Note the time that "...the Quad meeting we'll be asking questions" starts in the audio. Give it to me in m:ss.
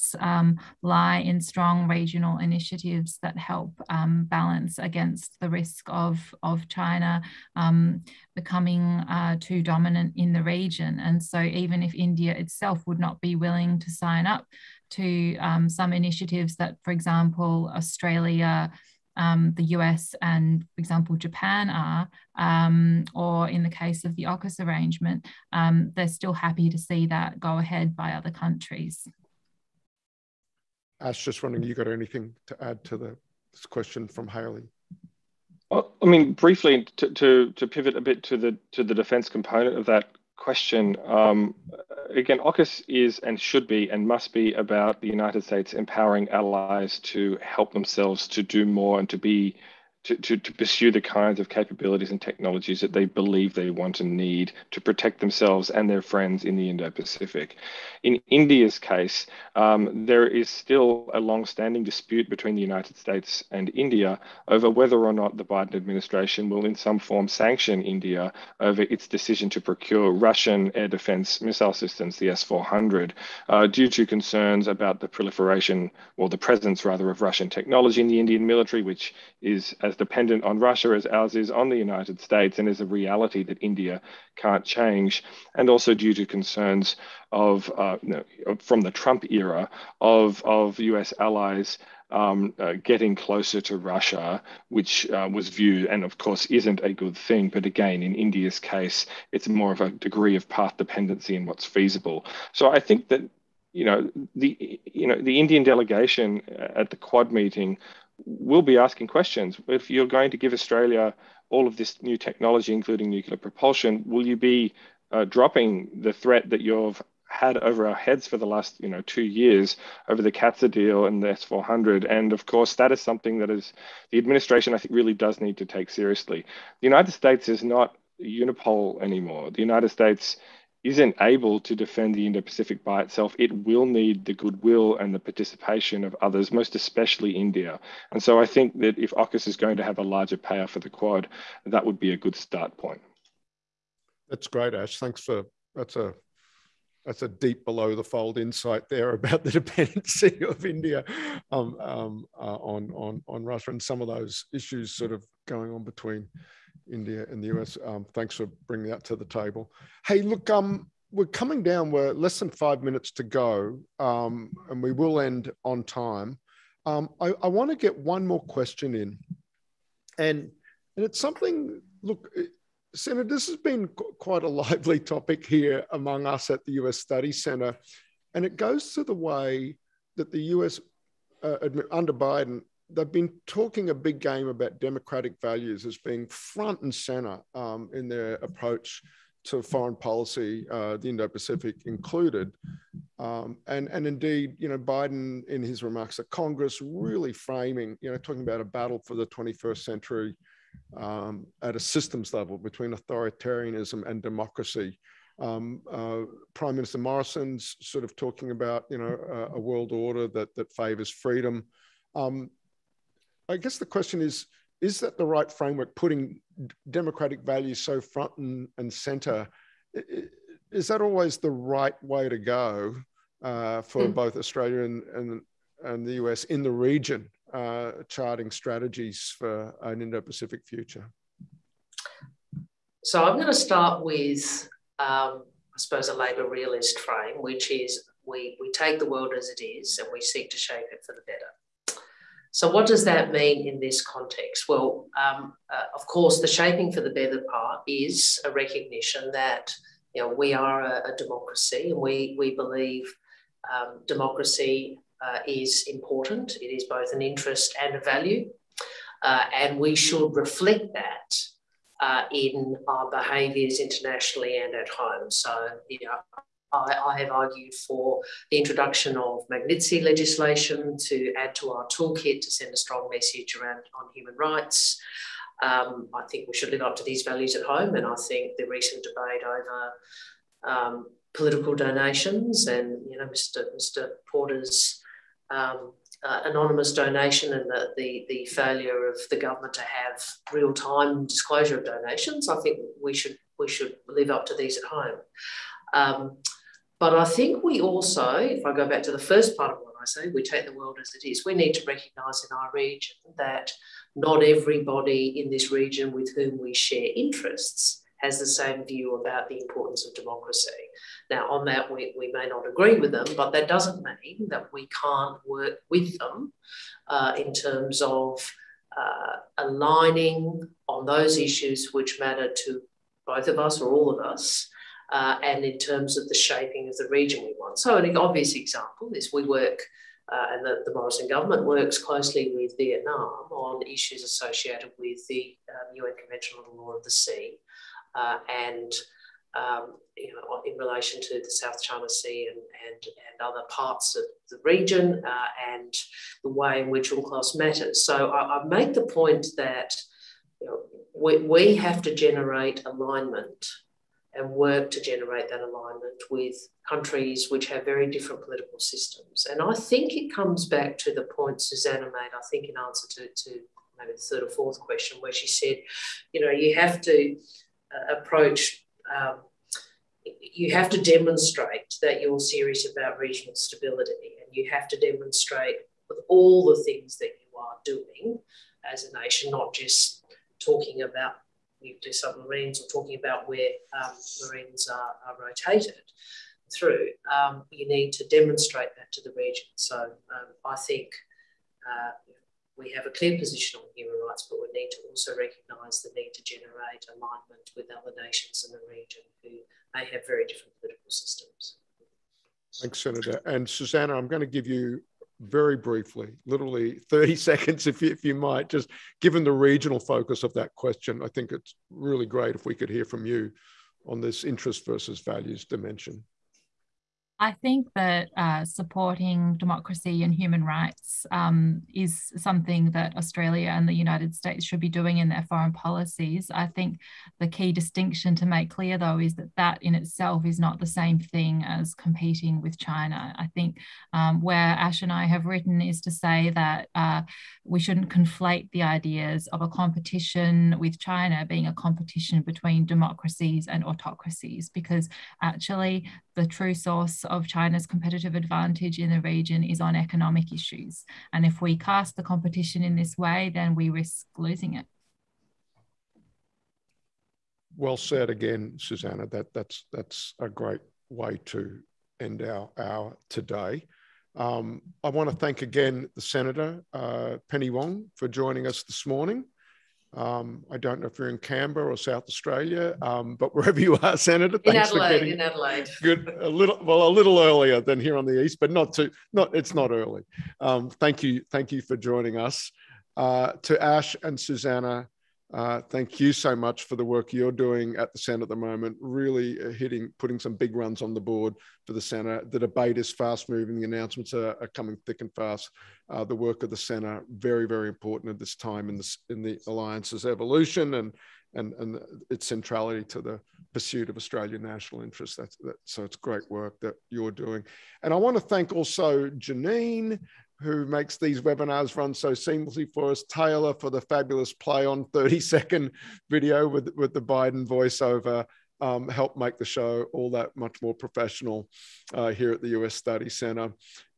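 1:46.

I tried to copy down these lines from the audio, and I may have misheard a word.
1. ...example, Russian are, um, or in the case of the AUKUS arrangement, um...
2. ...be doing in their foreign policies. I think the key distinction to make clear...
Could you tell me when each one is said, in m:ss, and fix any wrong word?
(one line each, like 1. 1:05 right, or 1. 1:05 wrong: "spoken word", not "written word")
1. 0:20 wrong: "Japan", not "Russian"
2. 7:04 right.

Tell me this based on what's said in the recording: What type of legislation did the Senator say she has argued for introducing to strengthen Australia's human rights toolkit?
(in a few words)
Magnitsky legislation.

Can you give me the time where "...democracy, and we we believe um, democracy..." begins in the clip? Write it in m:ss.
4:11.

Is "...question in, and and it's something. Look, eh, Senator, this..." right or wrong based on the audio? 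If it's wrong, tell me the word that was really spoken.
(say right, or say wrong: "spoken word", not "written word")
right.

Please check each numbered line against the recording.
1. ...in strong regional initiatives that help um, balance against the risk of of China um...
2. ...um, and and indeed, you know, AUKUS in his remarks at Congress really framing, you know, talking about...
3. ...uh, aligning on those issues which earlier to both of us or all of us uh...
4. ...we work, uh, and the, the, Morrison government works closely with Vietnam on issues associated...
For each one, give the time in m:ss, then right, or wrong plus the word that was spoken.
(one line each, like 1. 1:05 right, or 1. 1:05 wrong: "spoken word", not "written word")
1. 0:01 right
2. 3:13 wrong: "Biden", not "AUKUS"
3. 5:18 wrong: "matter", not "earlier"
4. 5:29 right.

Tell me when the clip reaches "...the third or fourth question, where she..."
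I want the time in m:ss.
6:04.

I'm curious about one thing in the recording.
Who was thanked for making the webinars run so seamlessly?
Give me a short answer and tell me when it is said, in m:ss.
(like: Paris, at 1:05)
Janine, at 8:29.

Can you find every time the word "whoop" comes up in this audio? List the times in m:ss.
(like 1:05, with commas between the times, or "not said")
not said.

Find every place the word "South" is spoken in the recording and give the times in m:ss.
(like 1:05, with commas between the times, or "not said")
5:41, 7:51.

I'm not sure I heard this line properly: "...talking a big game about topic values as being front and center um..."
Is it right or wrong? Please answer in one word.
wrong.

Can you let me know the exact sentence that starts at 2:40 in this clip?
Hey, look, um, we're coming down.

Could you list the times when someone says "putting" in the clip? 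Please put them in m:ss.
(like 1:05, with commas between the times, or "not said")
3:35, 8:10.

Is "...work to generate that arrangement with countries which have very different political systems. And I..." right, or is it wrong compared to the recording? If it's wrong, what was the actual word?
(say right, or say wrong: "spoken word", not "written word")
wrong: "alignment", not "arrangement".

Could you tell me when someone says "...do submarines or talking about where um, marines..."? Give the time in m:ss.
6:22.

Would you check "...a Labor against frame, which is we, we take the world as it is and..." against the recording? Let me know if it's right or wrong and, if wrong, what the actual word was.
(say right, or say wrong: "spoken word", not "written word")
wrong: "realist", not "against".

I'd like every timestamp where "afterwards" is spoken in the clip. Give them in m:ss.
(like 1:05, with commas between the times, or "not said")
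not said.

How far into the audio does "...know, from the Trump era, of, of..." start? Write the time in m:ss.
1:28.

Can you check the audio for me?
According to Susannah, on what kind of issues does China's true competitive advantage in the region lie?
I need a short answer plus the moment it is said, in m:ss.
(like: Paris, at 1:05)
Economic issues, at 7:29.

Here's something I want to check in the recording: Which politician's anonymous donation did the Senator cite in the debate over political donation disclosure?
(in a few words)
Porter.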